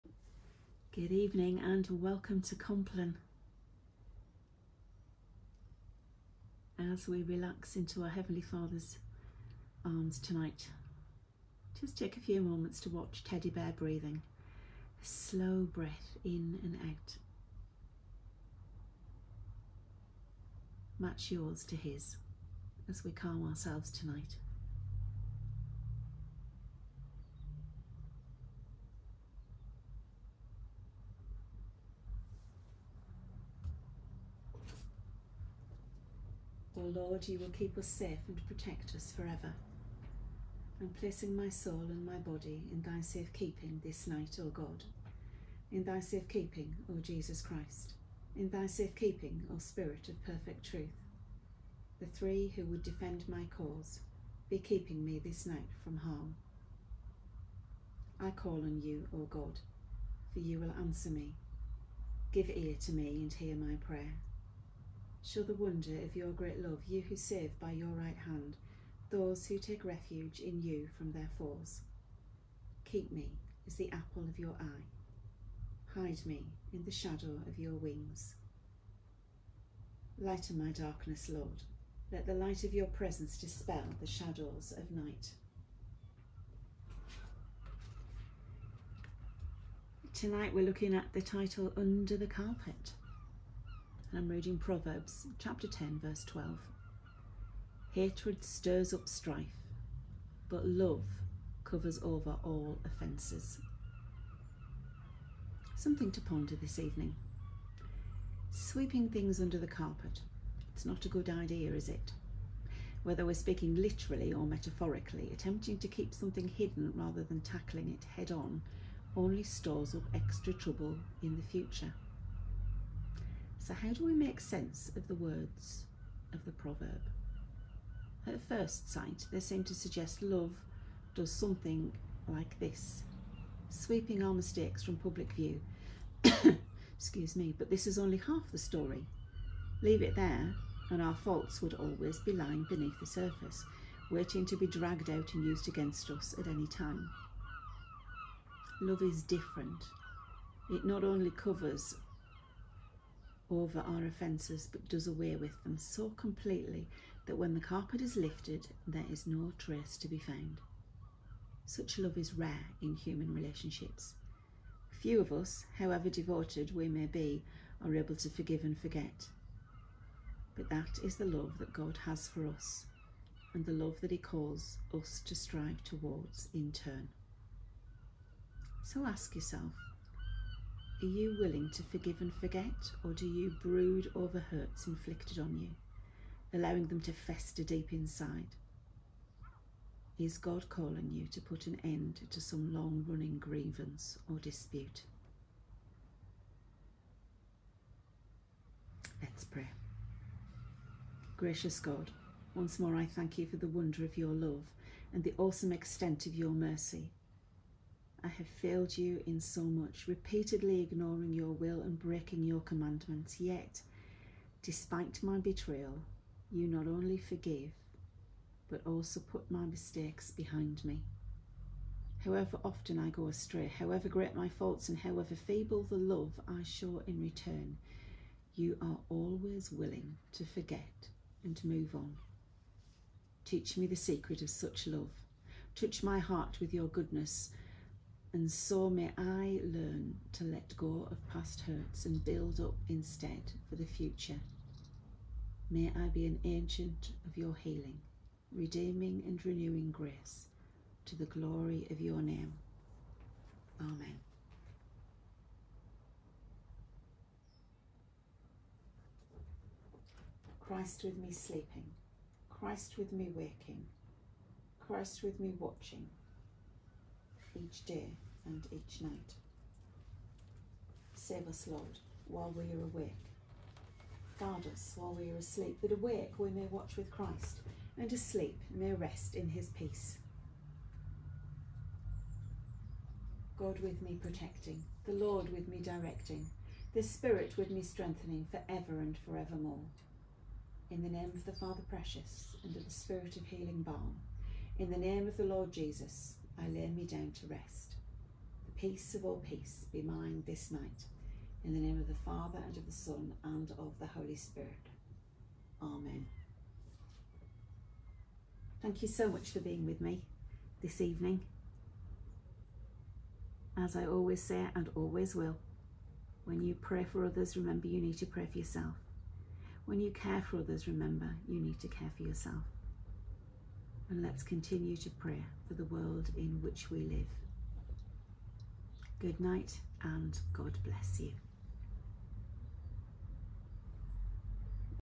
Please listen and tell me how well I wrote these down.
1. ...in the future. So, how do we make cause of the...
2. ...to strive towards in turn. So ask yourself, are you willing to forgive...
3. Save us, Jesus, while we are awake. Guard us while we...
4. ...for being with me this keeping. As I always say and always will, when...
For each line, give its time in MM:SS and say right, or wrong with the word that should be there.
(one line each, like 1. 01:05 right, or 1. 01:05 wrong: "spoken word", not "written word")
1. 02:01 wrong: "sense", not "cause"
2. 02:55 right
3. 04:31 wrong: "Lord", not "Jesus"
4. 05:09 wrong: "evening", not "keeping".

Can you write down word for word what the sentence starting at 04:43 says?
God with me protecting, the Lord with me directing, the Spirit with me strengthening for ever and forevermore.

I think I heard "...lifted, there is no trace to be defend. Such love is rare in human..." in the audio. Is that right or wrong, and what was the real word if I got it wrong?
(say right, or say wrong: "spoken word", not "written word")
wrong: "found", not "defend".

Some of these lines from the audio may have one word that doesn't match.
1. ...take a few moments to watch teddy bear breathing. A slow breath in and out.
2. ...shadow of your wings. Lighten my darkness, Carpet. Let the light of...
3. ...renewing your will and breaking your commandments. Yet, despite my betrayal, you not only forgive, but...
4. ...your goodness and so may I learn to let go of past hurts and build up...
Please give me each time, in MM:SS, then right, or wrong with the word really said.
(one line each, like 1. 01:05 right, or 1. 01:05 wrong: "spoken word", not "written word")
1. 00:11 right
2. 01:16 wrong: "Lord", not "Carpet"
3. 03:30 wrong: "ignoring", not "renewing"
4. 03:56 right.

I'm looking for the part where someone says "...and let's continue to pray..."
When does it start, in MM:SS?
05:24.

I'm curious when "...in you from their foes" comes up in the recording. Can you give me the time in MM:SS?
01:10.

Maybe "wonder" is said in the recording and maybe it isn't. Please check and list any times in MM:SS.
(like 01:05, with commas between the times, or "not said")
01:05, 03:23.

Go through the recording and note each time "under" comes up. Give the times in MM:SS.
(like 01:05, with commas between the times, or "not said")
01:31, 01:49.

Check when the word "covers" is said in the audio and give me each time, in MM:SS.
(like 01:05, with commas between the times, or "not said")
01:41, 02:31.